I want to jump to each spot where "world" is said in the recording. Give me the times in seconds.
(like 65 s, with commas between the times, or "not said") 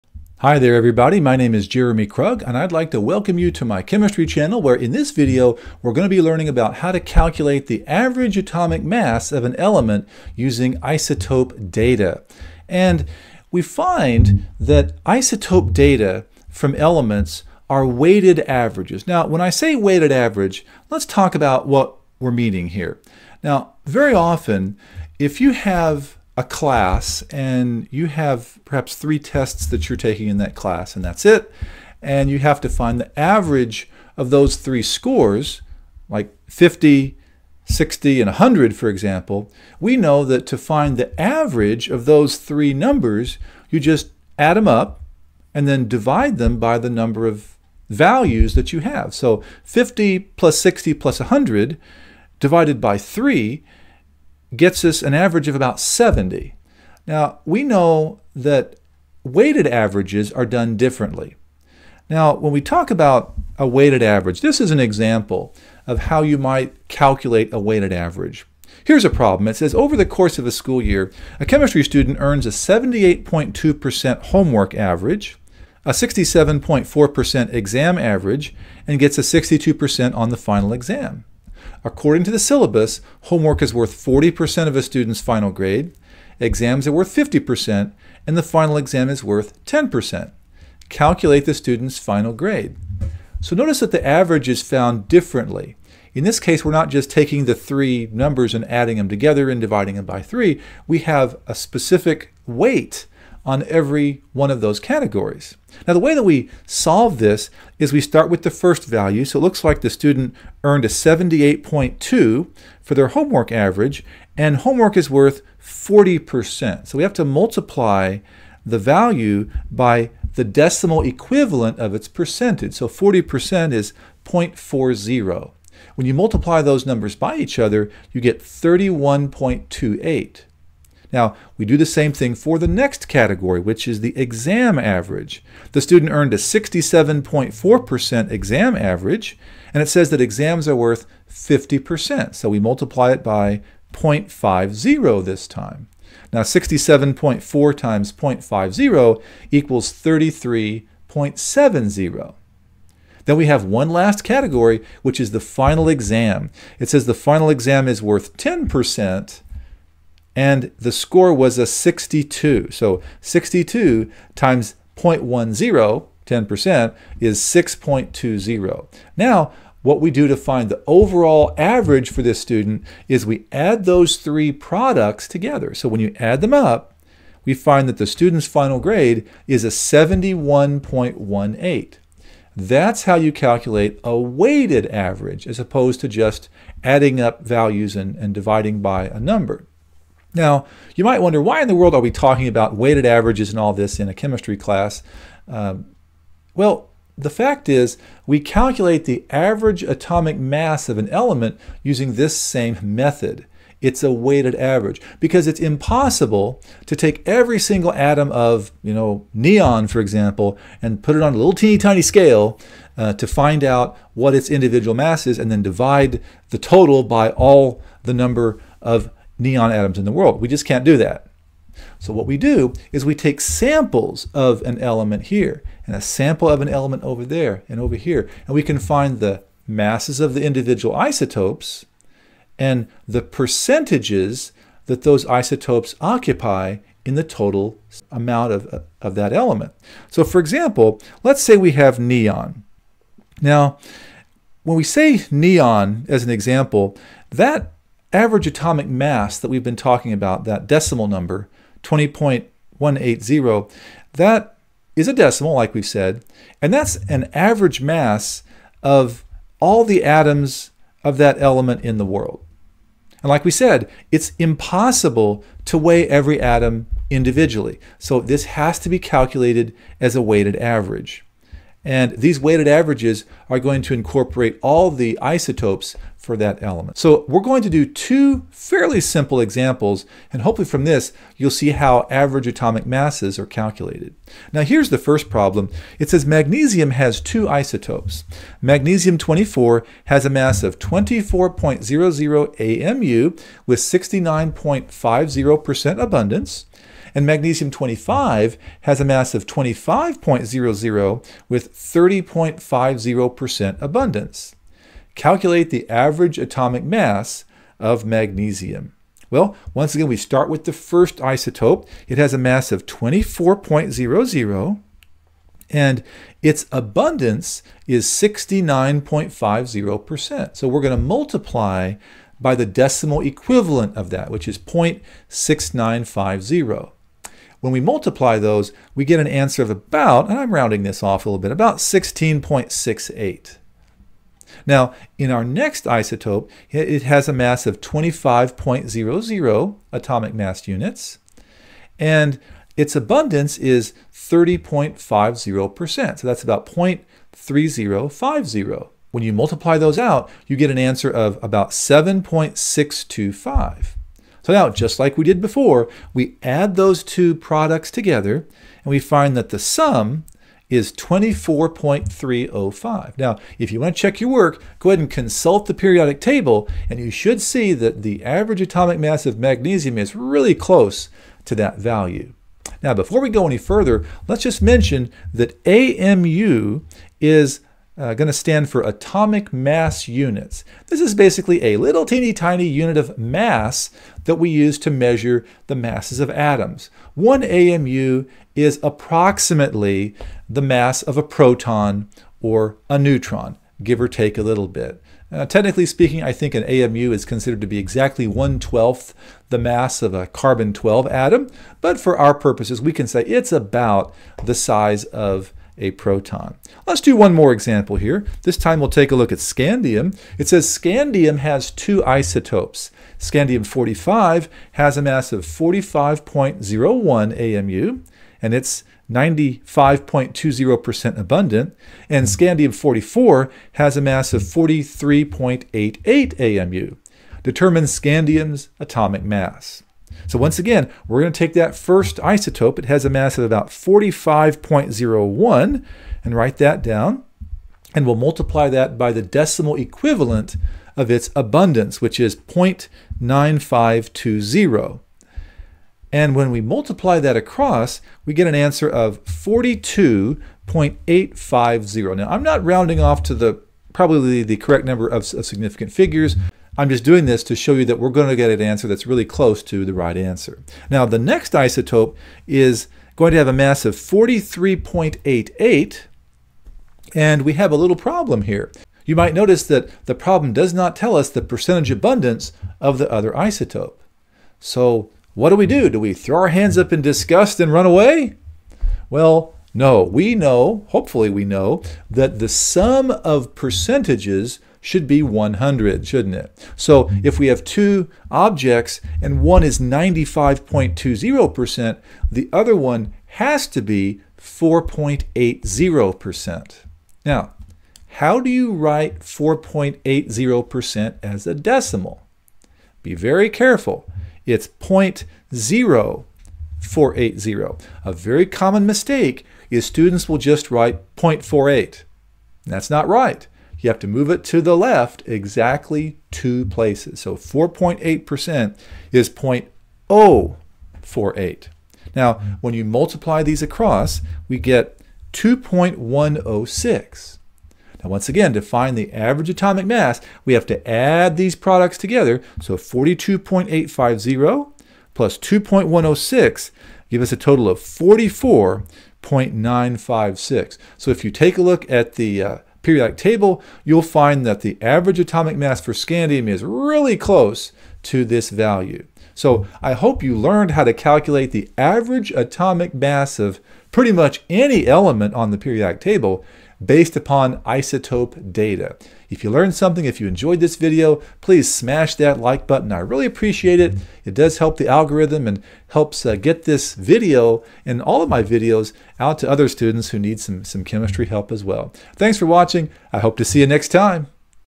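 191 s, 220 s, 262 s.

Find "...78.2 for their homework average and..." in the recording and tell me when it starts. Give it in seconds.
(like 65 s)
110 s.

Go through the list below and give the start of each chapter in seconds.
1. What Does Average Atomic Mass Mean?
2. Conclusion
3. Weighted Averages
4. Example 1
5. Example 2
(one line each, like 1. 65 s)
1. 240 s
2. 550 s
3. 62 s
4. 284 s
5. 407 s.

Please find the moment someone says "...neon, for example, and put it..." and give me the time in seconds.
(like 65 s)
209 s.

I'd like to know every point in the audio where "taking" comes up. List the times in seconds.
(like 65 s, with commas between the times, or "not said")
29 s, 97 s.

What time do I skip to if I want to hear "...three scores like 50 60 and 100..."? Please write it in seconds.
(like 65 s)
34 s.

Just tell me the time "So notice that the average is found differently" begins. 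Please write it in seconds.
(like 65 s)
93 s.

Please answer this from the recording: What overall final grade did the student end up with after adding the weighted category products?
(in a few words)
71.18.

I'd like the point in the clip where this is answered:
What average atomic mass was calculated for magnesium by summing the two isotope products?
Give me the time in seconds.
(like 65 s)
360 s.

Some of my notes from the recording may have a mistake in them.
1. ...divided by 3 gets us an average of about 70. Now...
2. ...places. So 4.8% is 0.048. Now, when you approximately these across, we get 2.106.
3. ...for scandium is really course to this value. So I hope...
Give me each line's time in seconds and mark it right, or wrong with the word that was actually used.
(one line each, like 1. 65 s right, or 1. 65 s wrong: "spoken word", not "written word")
1. 52 s right
2. 516 s wrong: "multiply", not "approximately"
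3. 545 s wrong: "close", not "course".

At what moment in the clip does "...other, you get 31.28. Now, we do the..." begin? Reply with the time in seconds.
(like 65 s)
127 s.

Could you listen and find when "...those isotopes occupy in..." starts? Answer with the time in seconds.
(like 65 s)
235 s.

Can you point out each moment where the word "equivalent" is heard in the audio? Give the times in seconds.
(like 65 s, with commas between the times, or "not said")
121 s, 323 s, 439 s.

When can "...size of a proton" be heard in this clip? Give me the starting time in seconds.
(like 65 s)
404 s.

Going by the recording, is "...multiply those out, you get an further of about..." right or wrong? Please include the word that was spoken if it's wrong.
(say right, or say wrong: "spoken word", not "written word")
wrong: "answer", not "further".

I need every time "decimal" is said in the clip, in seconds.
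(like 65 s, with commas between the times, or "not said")
120 s, 250 s, 255 s, 322 s, 439 s, 501 s.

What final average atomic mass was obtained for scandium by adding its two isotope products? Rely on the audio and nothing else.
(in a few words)
44.956.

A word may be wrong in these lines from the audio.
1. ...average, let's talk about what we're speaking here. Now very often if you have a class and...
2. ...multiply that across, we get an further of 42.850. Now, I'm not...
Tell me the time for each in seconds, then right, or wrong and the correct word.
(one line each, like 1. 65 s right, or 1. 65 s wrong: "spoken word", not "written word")
1. 20 s wrong: "meaning", not "speaking"
2. 446 s wrong: "answer", not "further".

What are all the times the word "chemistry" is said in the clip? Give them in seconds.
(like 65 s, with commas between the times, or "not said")
3 s, 71 s, 194 s, 570 s.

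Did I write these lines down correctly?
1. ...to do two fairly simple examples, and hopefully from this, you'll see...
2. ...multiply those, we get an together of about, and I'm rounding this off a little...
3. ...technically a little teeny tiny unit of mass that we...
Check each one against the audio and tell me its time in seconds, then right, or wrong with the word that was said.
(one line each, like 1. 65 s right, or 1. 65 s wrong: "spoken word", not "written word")
1. 277 s right
2. 327 s wrong: "answer", not "together"
3. 381 s wrong: "basically", not "technically".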